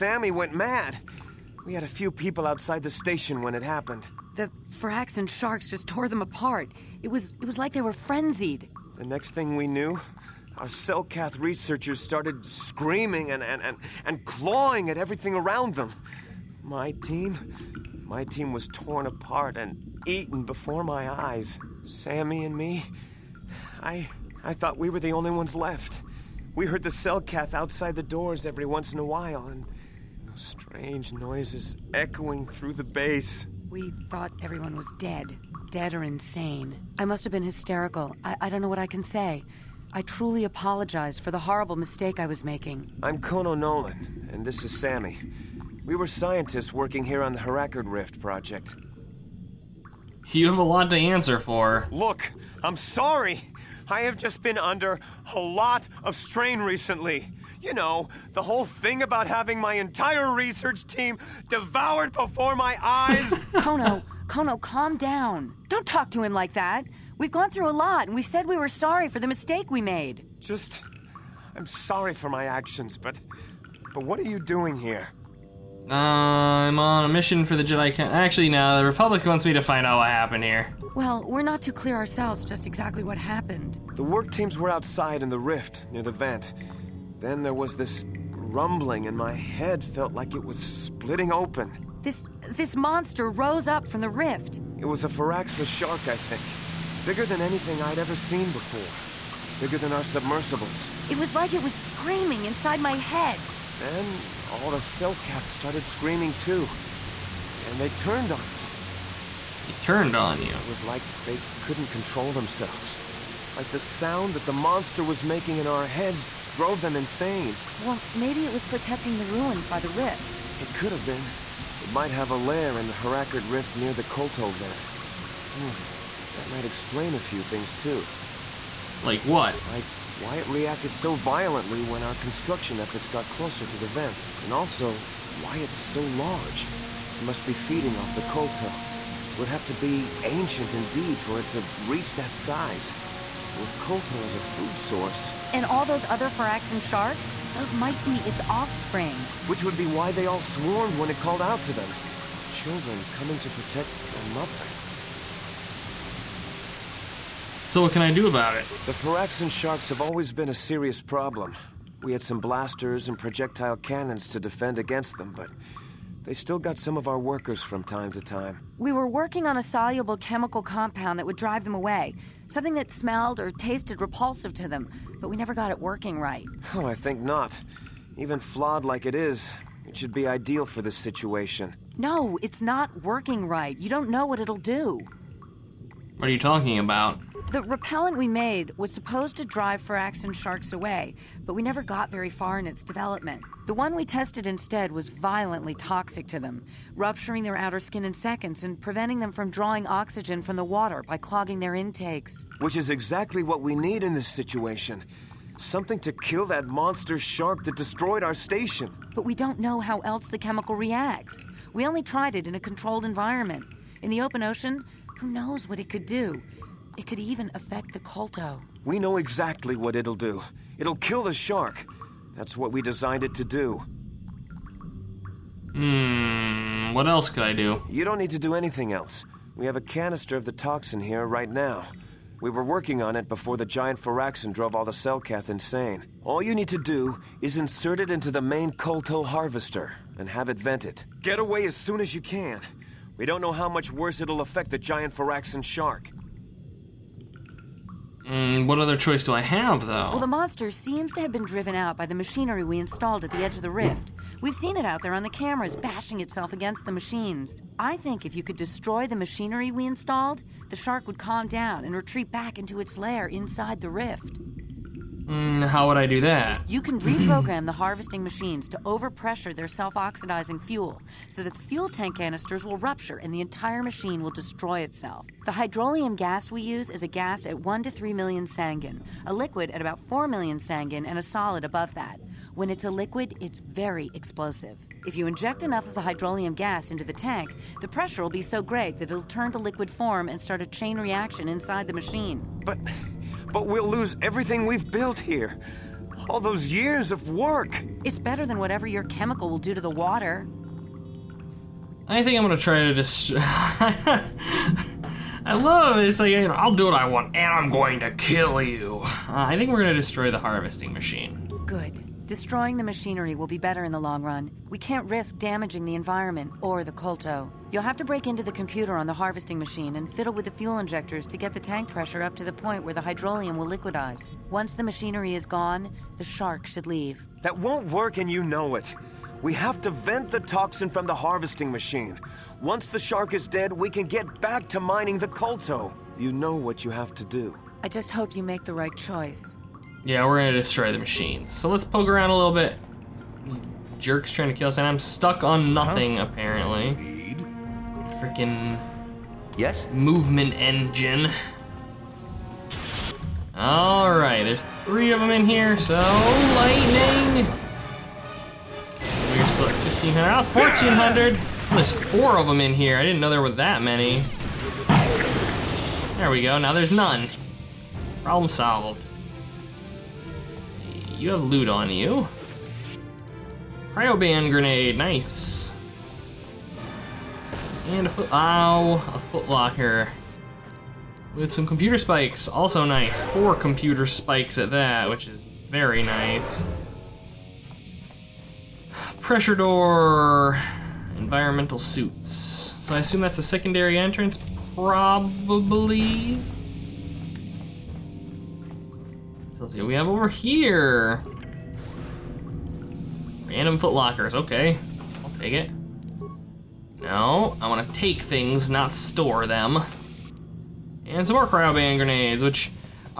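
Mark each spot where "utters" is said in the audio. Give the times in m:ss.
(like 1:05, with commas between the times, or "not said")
not said.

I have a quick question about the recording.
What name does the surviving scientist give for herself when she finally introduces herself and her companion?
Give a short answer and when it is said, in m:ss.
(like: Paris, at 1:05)
Kono Nolan, at 0:43.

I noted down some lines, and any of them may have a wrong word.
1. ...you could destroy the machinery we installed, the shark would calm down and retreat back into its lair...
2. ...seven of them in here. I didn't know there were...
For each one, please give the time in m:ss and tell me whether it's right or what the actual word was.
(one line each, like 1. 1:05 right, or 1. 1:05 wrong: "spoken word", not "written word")
1. 4:18 right
2. 6:01 wrong: "four", not "seven".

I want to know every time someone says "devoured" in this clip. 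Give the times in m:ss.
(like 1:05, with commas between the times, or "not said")
1:01.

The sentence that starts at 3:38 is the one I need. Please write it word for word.
We know exactly what it'll do.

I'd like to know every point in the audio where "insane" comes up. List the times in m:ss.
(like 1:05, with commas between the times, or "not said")
0:36, 1:56, 3:55.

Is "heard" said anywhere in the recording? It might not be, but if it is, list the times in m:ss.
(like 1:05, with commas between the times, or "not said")
0:26.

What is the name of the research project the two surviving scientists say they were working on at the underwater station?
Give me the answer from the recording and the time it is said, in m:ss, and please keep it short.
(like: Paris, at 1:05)
Hrakert Rift project, at 0:47.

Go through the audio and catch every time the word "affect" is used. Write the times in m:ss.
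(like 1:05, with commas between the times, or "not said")
3:37, 4:04.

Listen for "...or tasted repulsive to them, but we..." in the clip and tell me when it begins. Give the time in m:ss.
2:53.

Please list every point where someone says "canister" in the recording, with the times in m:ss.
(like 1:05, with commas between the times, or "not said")
3:49, 4:32.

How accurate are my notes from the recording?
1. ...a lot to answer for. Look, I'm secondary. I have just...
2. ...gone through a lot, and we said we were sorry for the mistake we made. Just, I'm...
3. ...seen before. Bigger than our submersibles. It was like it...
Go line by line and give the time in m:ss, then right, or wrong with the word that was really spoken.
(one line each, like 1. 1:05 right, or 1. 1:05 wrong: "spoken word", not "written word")
1. 0:50 wrong: "sorry", not "secondary"
2. 1:07 right
3. 1:38 right.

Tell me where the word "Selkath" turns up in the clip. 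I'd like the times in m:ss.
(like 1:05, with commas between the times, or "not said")
0:10, 1:44, 3:54.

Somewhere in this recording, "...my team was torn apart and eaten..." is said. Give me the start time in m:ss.
0:18.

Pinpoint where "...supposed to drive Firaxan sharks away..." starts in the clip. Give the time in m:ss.
3:08.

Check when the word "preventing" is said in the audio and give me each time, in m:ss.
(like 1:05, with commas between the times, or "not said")
3:18.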